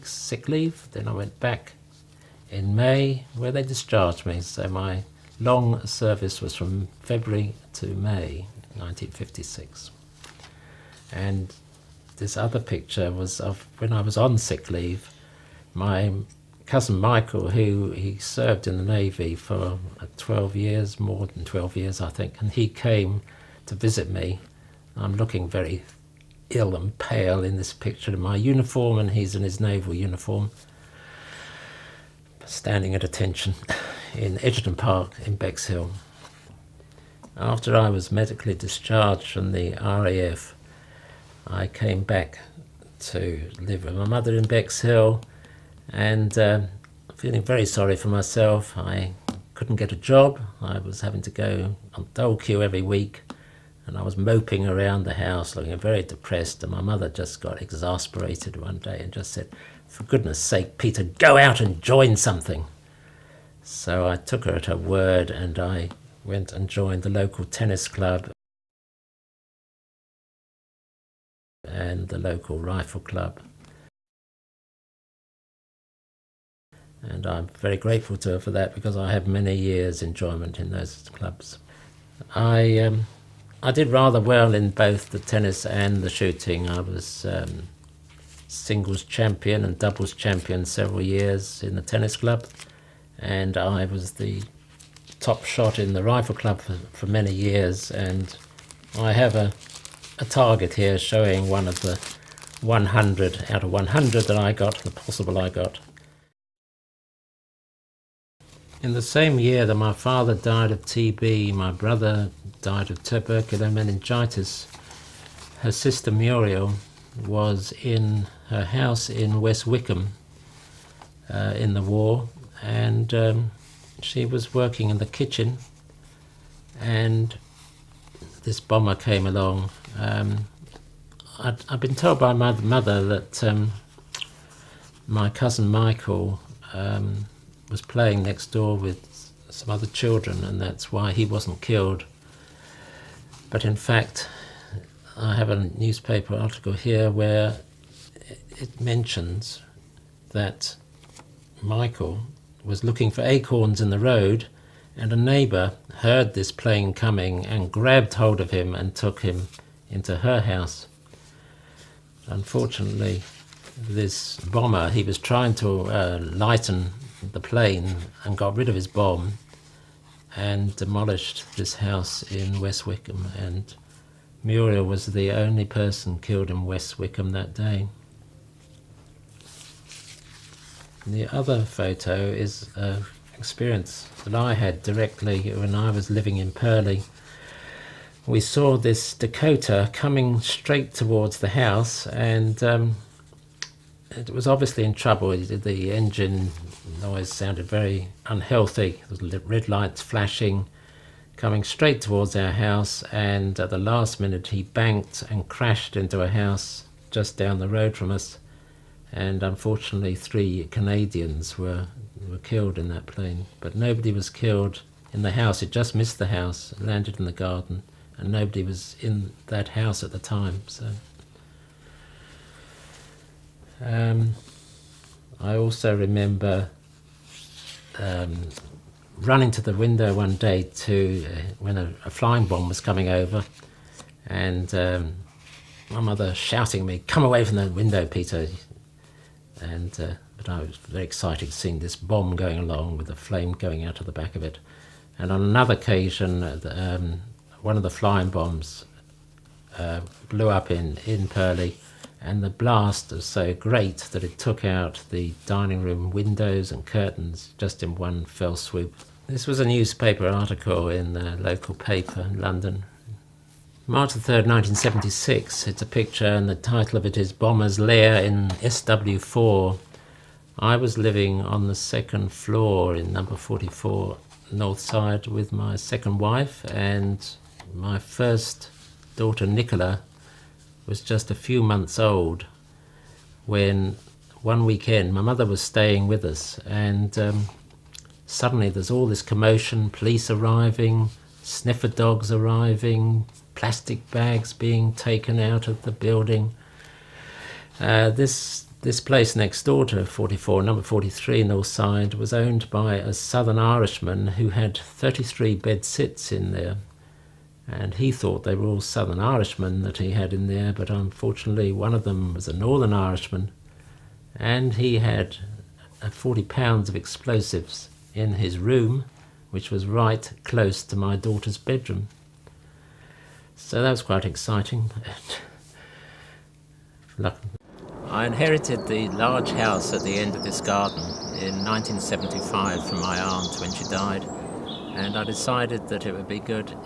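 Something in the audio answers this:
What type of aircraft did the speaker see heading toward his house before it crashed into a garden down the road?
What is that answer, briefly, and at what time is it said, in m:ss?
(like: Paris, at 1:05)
Dakota, at 3:09.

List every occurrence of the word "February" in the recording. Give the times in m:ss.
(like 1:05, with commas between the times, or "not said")
0:07.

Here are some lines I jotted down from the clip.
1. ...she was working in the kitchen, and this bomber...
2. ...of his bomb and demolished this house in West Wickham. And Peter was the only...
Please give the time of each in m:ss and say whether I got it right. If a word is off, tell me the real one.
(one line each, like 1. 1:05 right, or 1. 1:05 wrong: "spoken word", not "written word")
1. 2:03 right
2. 2:48 wrong: "Muriel", not "Peter".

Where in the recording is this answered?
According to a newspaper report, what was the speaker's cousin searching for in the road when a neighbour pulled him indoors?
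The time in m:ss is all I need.
2:33.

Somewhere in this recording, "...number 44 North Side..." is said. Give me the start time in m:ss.
4:33.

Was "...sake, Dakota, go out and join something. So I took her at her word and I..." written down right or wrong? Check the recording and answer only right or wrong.
wrong.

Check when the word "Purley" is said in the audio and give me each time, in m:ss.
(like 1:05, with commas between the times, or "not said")
3:06, 4:11.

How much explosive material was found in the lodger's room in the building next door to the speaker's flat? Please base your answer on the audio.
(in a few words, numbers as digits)
40 pounds.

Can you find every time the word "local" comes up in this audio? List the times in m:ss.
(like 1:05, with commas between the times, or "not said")
1:07, 1:12, 4:21.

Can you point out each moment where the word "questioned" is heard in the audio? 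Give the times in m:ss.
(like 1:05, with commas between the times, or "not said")
not said.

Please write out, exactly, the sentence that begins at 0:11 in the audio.
And this other picture was of when I was on sick leave.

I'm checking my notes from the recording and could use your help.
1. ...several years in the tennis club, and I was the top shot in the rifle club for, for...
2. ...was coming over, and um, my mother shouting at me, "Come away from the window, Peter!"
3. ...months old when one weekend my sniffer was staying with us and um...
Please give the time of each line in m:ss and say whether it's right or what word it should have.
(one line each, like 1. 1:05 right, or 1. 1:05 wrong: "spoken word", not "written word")
1. 1:30 right
2. 3:52 right
3. 4:41 wrong: "mother", not "sniffer".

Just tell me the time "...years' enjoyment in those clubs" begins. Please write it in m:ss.
1:19.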